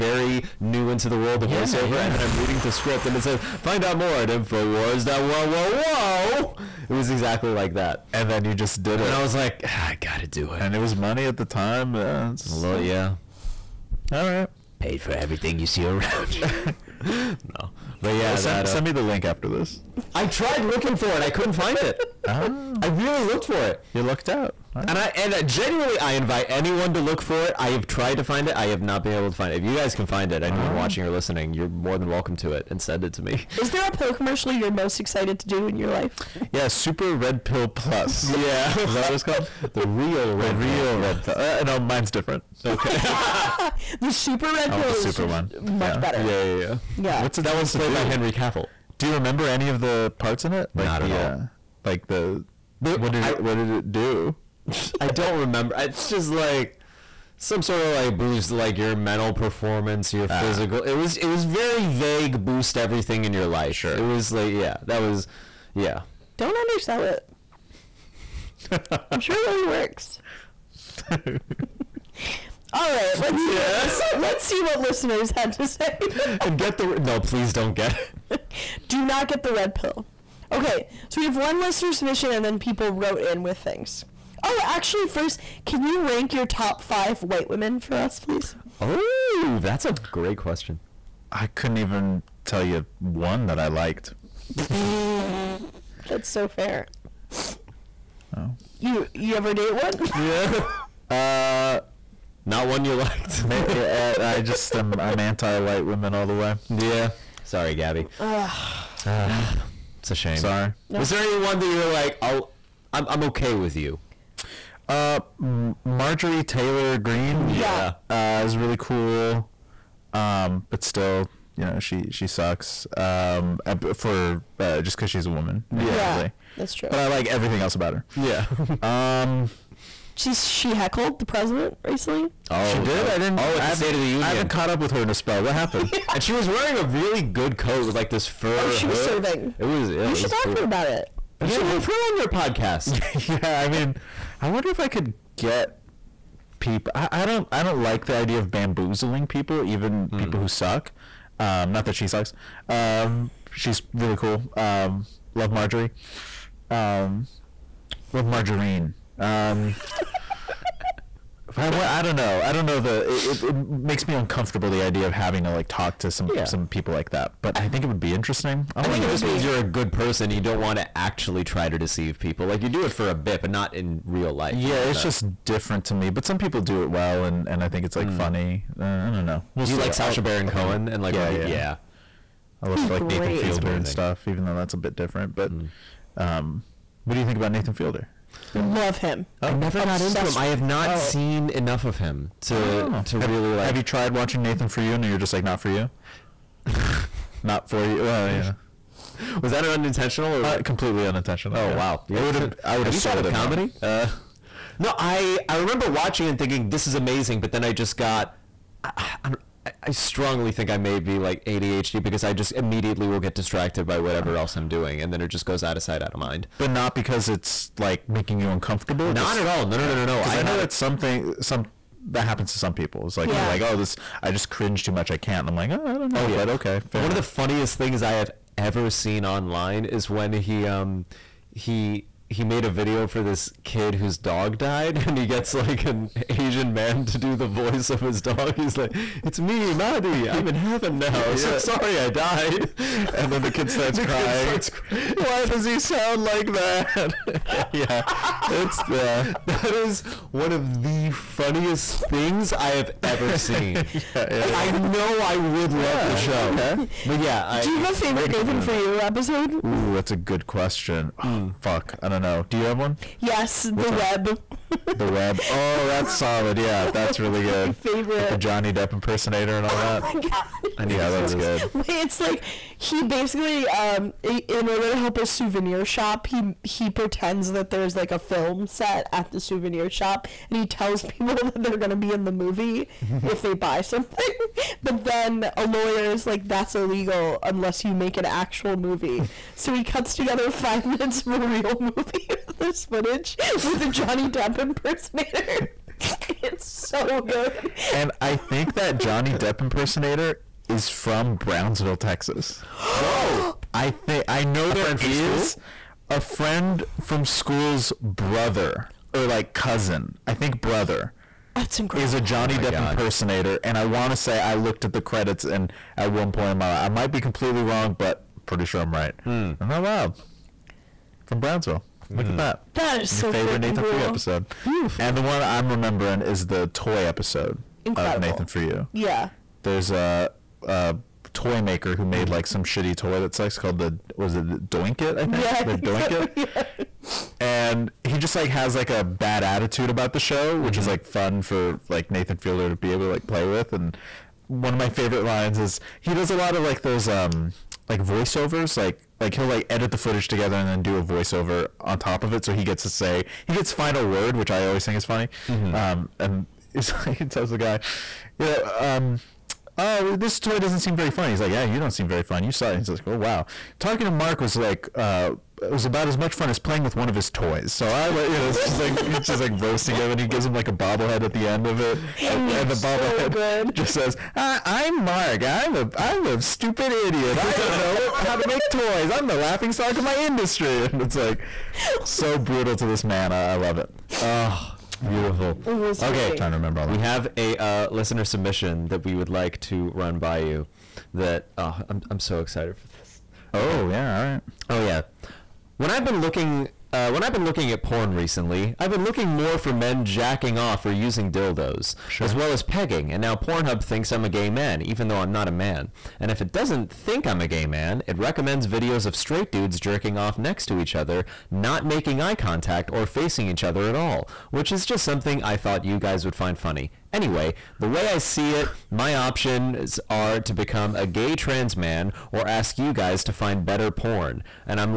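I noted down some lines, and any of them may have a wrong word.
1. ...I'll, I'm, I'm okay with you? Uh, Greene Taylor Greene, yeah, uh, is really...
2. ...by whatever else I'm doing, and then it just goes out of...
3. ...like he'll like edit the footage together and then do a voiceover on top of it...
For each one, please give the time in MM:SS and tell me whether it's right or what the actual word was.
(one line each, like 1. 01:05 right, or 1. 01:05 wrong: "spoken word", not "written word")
1. 01:52 wrong: "Marjorie", not "Greene"
2. 03:33 right
3. 05:49 right.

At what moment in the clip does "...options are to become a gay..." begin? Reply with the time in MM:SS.
06:59.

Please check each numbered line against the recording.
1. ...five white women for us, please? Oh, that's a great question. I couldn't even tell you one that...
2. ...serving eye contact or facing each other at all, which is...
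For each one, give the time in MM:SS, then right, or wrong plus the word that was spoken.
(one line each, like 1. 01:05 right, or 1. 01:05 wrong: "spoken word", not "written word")
1. 01:26 right
2. 06:51 wrong: "making", not "serving".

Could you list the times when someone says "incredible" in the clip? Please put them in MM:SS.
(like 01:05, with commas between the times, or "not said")
05:11, 05:27.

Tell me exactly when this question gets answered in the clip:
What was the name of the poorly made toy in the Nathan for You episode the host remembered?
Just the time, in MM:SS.
05:34.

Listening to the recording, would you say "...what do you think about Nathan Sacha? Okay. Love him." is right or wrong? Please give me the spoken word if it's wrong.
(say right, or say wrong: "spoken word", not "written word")
wrong: "Fielder", not "Sacha".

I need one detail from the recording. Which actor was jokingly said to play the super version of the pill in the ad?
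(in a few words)
Henry Cavill.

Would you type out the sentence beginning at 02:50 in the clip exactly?
You don't want to actually try to deceive people.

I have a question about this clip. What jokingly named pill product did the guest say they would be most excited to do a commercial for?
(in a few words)
Super Red Pill Plus.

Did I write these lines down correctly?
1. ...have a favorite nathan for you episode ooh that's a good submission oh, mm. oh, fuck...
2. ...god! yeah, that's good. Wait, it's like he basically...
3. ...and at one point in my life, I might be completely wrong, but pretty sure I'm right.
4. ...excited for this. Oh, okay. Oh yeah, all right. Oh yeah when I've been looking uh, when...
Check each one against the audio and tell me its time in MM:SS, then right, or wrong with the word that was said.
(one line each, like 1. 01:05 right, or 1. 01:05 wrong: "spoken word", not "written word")
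1. 04:17 wrong: "question", not "submission"
2. 04:30 right
3. 05:15 right
4. 06:32 right.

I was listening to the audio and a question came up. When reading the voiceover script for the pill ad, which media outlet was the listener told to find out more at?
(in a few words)
Infowars.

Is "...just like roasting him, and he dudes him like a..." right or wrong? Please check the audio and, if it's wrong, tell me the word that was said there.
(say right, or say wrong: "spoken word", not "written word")
wrong: "gives", not "dudes".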